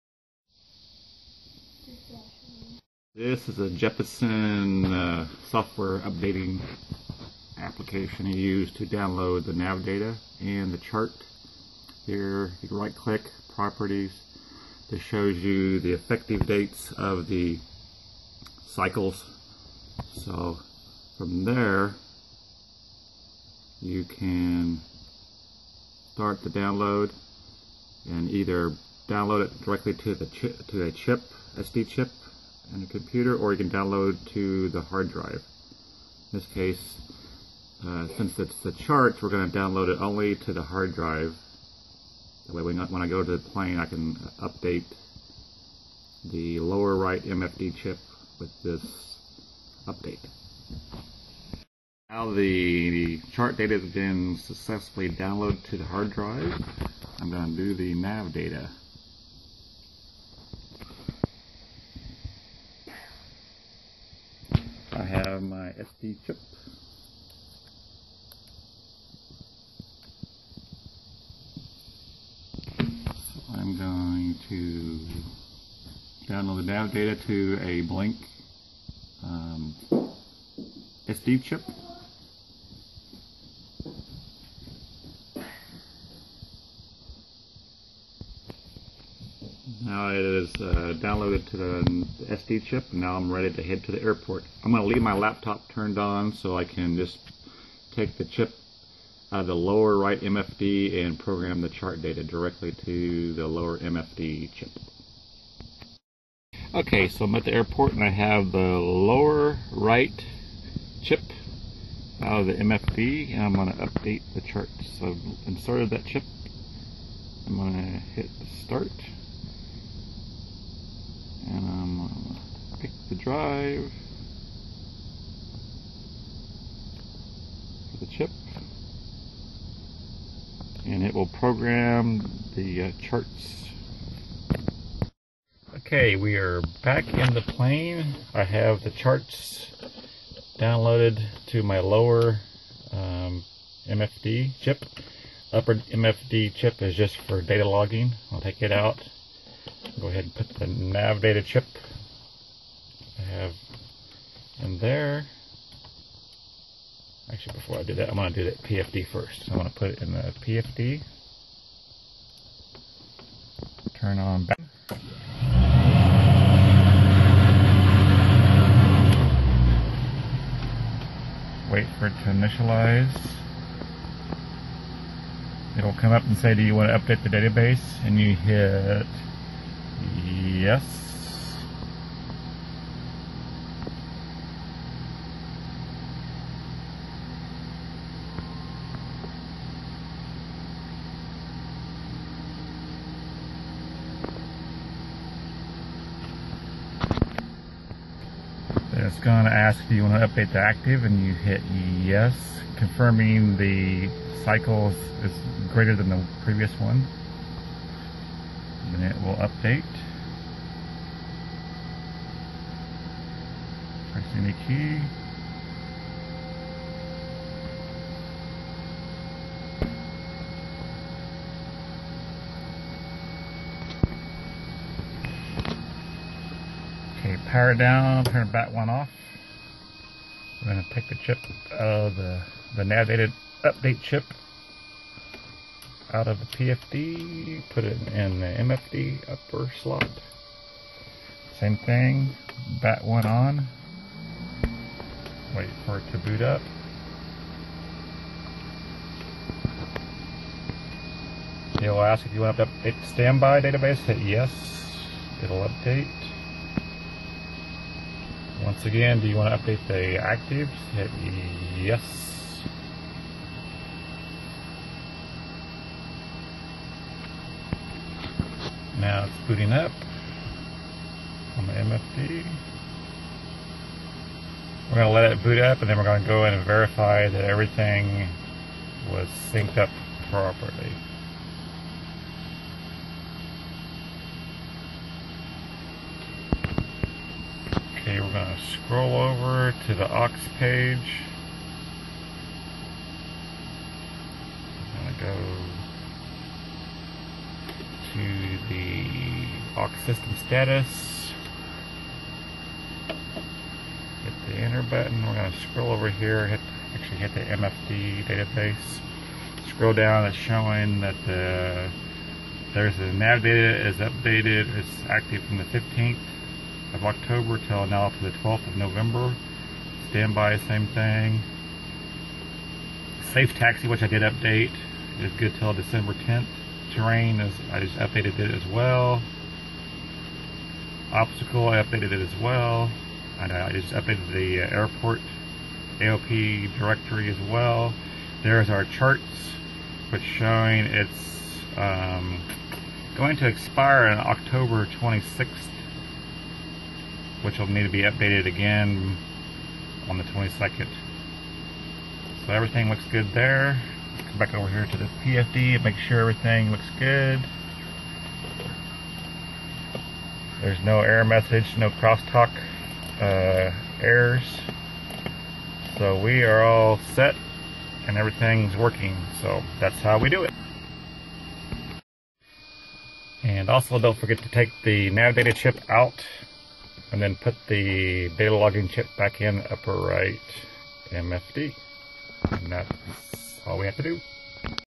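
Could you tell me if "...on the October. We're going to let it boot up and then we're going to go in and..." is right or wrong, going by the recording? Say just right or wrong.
wrong.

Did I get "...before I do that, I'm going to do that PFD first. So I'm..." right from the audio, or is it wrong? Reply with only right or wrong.
right.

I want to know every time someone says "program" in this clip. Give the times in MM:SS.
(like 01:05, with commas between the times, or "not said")
01:41, 02:11.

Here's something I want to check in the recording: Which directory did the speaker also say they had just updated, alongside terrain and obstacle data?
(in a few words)
AOPA directory.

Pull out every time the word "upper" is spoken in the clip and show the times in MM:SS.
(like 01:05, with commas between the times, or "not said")
02:25, 03:59, 06:19.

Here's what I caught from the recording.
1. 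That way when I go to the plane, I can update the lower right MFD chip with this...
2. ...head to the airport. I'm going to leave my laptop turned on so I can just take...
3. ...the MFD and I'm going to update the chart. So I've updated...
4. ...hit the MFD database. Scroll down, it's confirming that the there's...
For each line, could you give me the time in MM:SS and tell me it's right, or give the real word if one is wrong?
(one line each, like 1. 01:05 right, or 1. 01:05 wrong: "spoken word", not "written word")
1. 00:42 right
2. 01:33 right
3. 01:52 wrong: "inserted", not "updated"
4. 05:07 wrong: "showing", not "confirming".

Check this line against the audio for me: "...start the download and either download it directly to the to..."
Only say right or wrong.
right.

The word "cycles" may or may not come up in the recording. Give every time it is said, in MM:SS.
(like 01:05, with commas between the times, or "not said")
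00:18, 03:24.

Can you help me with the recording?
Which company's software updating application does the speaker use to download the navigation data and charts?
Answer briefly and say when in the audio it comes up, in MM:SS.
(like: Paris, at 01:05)
Jeppesen, at 00:03.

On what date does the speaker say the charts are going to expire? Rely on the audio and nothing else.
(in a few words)
October 26th.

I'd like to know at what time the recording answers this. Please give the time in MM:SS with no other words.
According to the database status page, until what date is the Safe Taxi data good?
05:25.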